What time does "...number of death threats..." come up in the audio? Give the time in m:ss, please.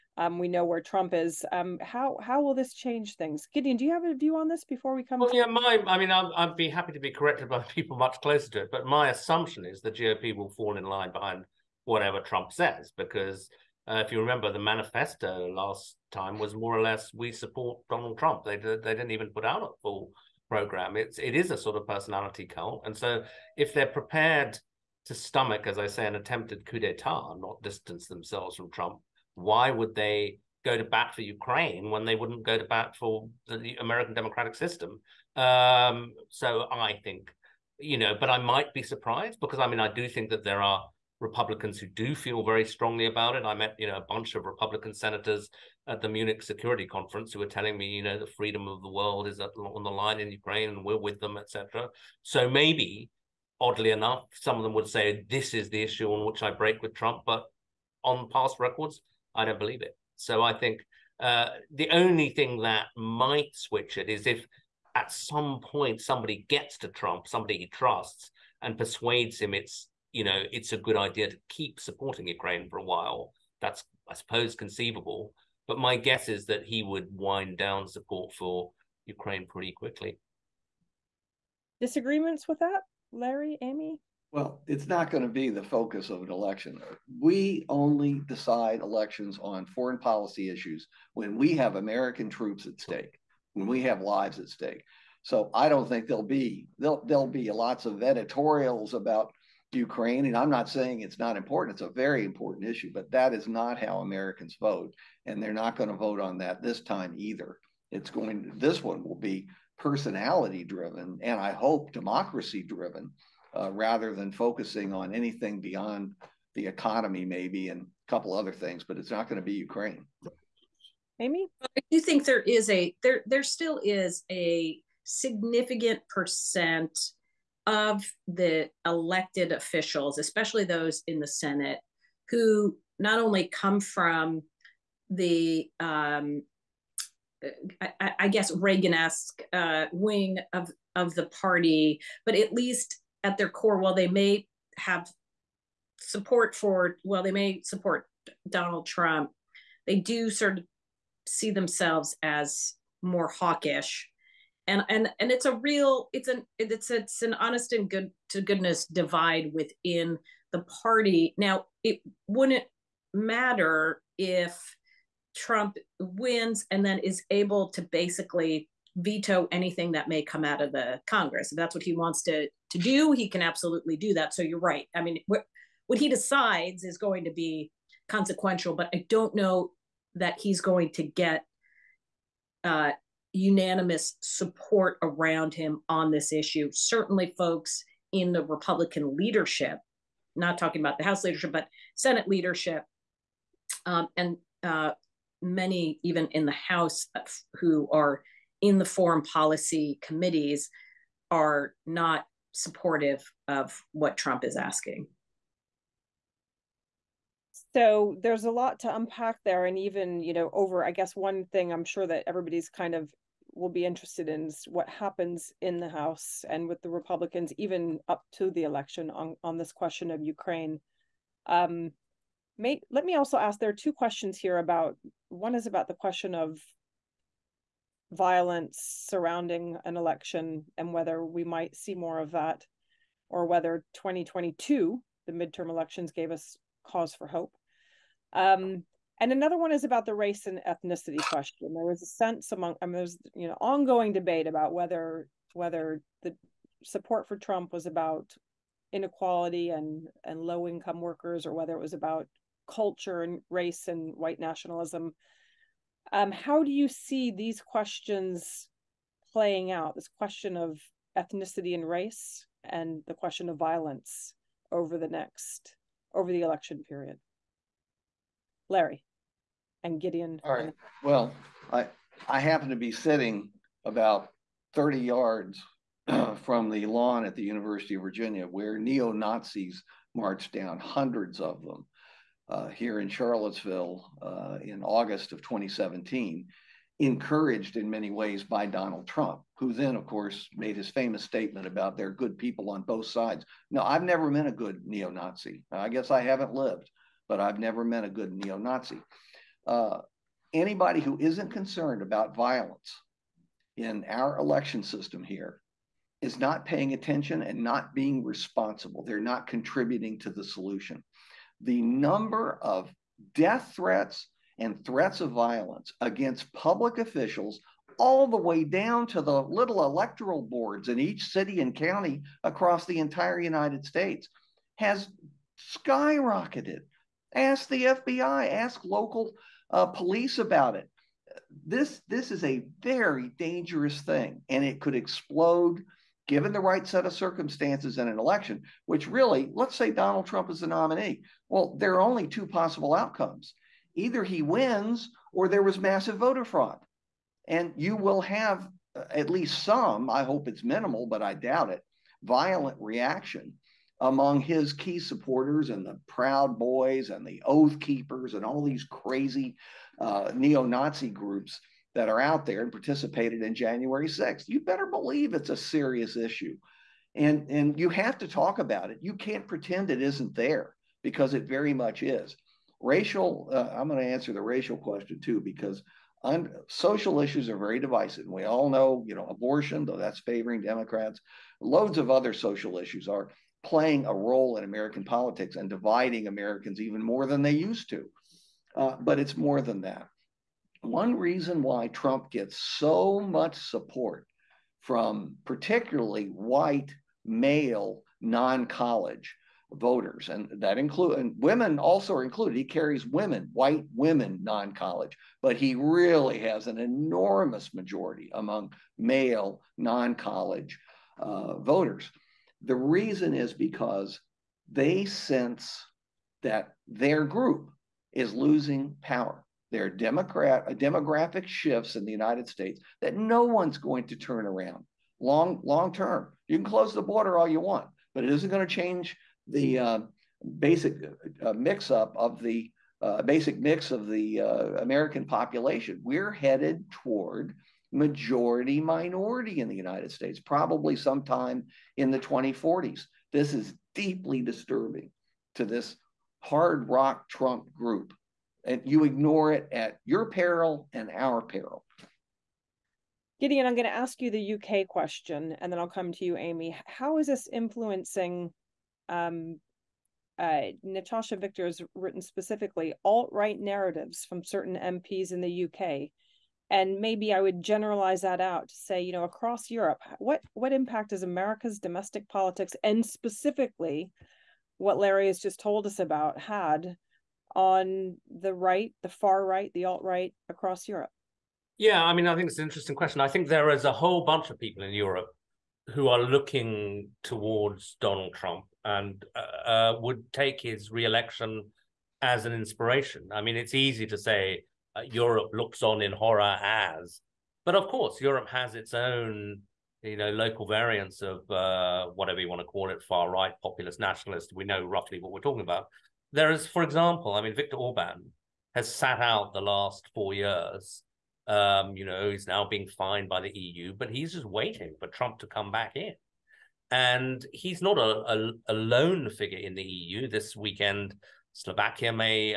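5:11.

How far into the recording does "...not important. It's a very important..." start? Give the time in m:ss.
1:41.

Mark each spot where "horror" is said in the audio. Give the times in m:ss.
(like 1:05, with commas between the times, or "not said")
8:16.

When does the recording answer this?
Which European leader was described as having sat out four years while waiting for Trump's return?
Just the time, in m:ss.
8:27.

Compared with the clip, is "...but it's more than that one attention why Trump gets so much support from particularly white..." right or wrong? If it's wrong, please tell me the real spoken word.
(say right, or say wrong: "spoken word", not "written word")
wrong: "reason", not "attention".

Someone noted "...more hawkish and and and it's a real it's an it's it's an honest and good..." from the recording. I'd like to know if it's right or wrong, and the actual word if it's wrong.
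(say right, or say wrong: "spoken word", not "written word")
right.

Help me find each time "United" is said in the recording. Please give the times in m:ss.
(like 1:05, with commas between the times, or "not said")
5:23, 7:02, 7:19.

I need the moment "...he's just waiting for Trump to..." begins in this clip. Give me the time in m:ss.
8:34.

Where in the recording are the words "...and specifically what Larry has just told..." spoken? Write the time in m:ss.
7:52.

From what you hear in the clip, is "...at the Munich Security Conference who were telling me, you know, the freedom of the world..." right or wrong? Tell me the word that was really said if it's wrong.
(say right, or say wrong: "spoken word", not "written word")
right.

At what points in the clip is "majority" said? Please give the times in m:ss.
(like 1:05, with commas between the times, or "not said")
6:47, 7:17.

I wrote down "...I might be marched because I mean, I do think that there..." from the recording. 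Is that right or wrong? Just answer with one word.
wrong.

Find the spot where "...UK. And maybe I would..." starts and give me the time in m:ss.
7:45.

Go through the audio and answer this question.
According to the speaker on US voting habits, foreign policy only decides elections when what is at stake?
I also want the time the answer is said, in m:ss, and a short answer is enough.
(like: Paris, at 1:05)
American troops, at 1:31.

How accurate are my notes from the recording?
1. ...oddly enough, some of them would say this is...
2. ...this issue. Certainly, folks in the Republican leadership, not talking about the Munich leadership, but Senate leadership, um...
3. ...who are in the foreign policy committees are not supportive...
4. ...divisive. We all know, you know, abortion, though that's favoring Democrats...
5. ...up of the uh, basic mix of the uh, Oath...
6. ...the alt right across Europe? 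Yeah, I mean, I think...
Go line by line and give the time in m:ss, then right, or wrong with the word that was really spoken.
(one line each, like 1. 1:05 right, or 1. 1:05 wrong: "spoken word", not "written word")
1. 0:53 right
2. 3:06 wrong: "House", not "Munich"
3. 3:17 right
4. 6:17 right
5. 7:11 wrong: "American", not "Oath"
6. 7:59 right.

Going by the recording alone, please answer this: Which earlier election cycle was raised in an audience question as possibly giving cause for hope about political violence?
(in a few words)
2022 midterms.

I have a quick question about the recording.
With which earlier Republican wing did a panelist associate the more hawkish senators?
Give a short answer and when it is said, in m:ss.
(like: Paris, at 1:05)
Reagan-esque, at 2:18.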